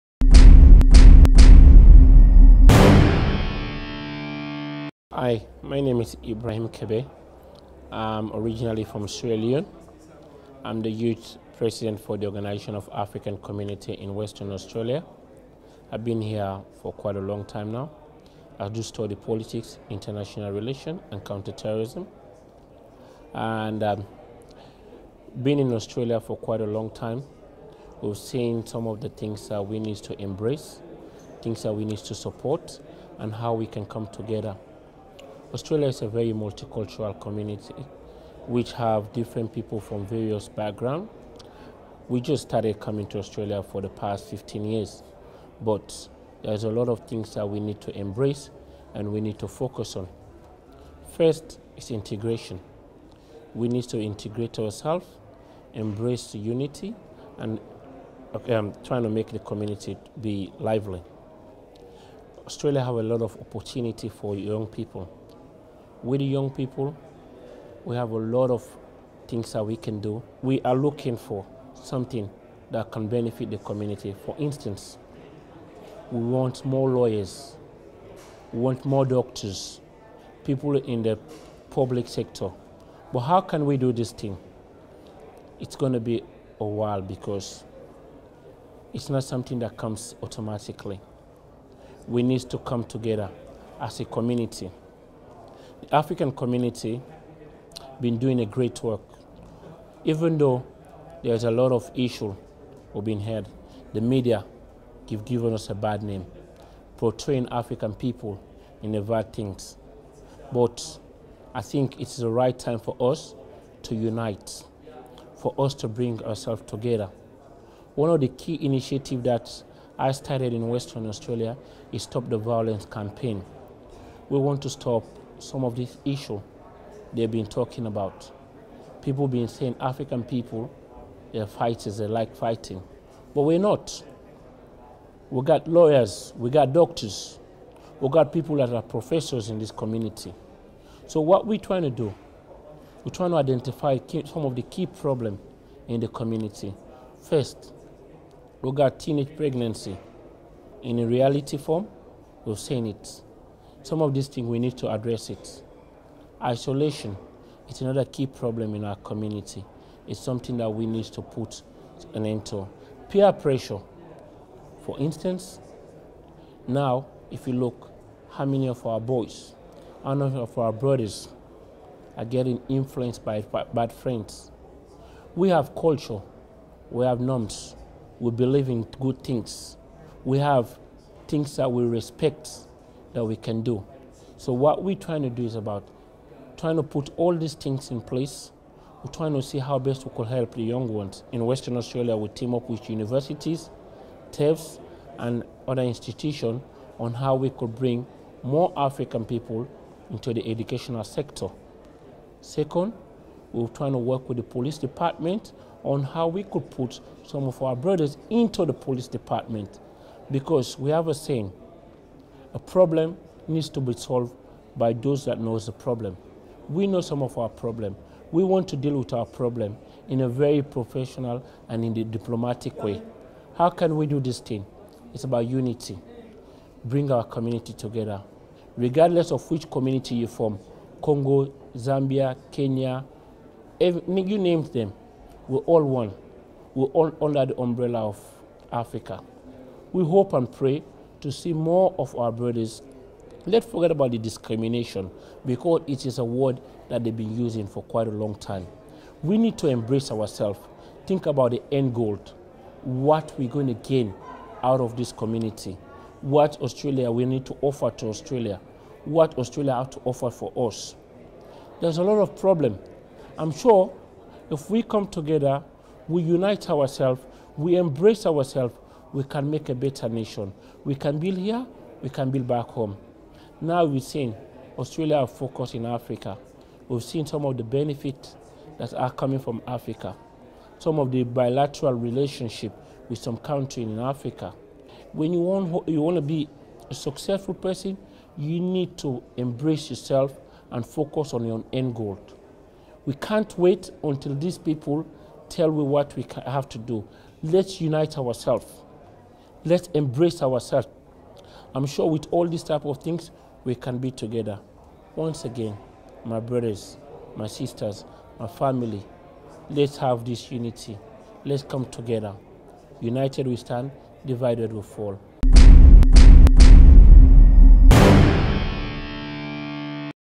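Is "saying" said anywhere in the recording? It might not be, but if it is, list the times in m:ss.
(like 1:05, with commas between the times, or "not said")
2:09, 3:31.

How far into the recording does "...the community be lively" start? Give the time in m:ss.
0:59.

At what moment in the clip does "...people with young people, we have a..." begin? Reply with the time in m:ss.
1:04.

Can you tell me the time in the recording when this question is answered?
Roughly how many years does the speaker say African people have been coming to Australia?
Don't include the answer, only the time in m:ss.
0:44.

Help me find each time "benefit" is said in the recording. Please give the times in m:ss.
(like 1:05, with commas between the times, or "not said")
1:13, 4:37.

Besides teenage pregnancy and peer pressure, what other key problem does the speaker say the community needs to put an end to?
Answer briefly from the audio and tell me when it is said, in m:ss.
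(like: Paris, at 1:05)
Isolation, at 2:36.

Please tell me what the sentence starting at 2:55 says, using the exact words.
We have culture, we have norms, we believe in good things, we have things that we respect that we can do.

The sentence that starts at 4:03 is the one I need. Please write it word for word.
Let's forget about the discrimination because it is a word that they've been using for quite a long time.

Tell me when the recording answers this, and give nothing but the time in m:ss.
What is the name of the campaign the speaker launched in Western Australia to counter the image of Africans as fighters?
2:02.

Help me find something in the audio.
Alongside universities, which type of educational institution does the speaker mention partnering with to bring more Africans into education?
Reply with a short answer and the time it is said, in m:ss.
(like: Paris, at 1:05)
TAFEs, at 3:14.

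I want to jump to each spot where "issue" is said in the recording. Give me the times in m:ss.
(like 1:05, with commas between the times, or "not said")
1:41, 2:06.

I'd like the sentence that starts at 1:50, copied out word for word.
But I think it's the right time for us to unite, for us to bring ourselves together.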